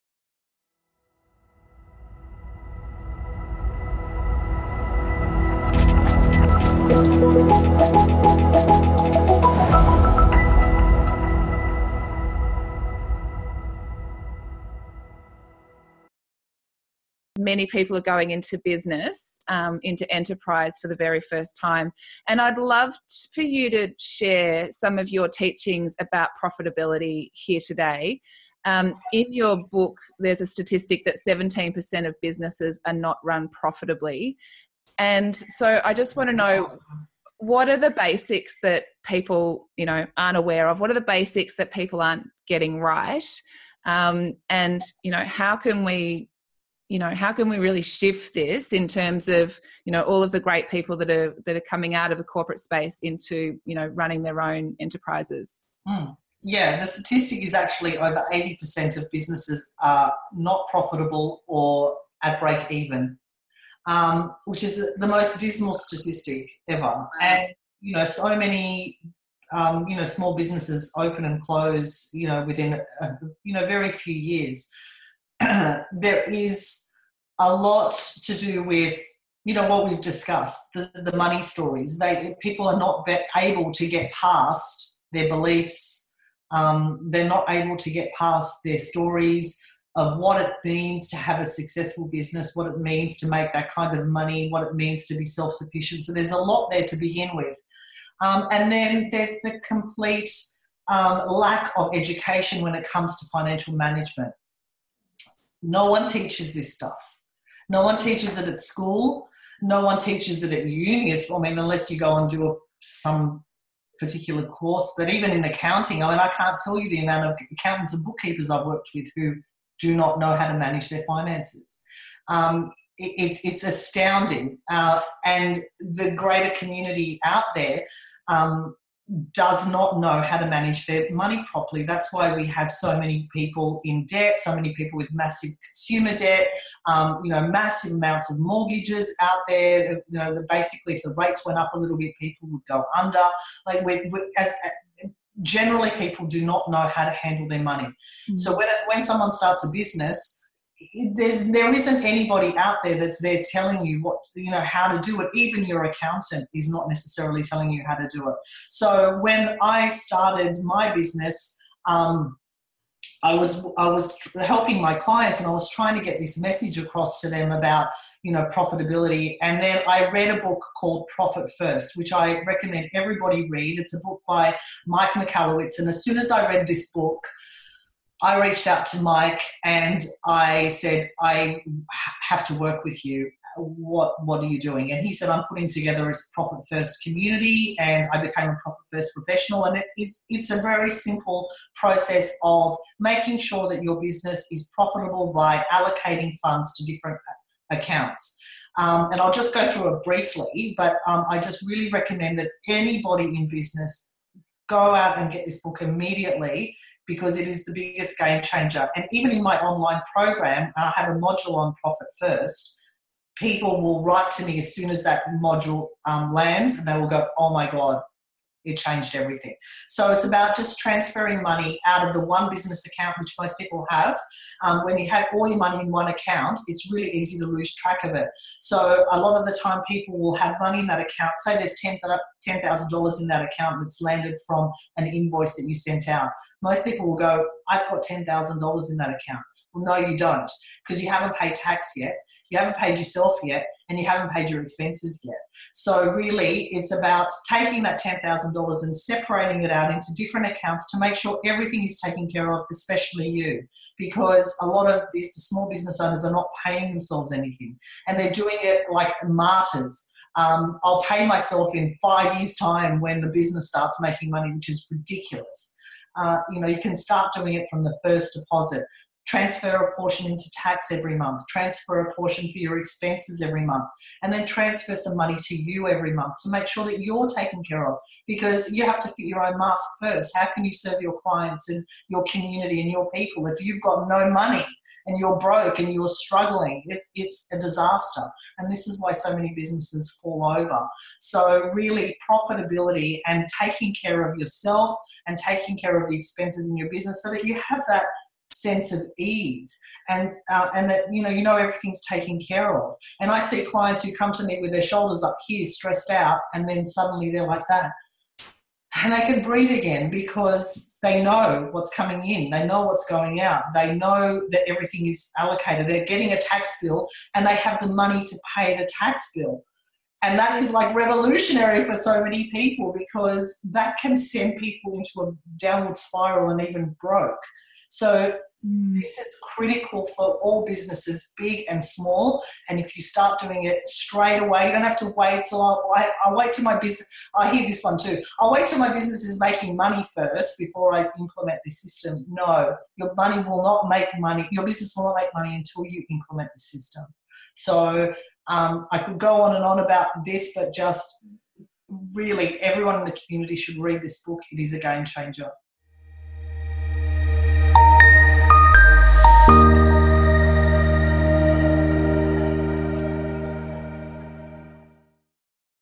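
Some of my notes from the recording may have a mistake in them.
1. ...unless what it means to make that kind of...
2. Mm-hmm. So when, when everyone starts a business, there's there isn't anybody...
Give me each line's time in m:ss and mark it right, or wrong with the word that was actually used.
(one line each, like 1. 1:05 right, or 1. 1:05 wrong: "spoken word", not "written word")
1. 1:32 wrong: "business", not "unless"
2. 2:27 wrong: "someone", not "everyone".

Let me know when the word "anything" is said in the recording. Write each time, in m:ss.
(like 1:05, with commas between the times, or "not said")
4:17.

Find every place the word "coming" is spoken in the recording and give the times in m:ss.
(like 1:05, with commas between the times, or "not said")
0:51, 5:11.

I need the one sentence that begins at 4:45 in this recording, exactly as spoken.
And you're broke and you're struggling.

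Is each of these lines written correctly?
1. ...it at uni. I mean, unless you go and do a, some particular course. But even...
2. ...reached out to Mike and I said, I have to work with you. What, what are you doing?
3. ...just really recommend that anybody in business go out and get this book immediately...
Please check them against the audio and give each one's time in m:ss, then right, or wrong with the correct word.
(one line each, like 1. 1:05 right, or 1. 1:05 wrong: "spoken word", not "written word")
1. 1:50 right
2. 2:58 right
3. 3:21 right.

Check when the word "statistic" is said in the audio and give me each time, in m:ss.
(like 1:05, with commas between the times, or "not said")
0:30, 0:56, 1:05.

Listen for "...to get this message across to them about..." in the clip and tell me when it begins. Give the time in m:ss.
2:45.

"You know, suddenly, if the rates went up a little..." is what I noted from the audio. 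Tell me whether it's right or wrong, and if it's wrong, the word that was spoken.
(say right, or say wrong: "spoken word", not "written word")
wrong: "basically", not "suddenly".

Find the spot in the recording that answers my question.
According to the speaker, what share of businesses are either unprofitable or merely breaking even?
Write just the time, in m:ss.
0:57.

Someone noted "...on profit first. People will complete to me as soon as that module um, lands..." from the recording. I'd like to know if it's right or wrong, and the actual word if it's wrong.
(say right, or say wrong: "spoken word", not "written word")
wrong: "write", not "complete".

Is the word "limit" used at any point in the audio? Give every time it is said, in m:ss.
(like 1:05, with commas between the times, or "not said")
not said.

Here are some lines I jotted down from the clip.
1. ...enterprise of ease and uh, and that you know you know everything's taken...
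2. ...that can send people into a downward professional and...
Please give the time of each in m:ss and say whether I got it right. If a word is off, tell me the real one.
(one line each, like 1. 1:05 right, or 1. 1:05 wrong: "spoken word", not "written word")
1. 4:58 wrong: "sense", not "enterprise"
2. 5:23 wrong: "spiral", not "professional".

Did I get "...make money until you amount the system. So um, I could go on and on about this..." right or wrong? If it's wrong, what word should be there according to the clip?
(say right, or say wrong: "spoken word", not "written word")
wrong: "implement", not "amount".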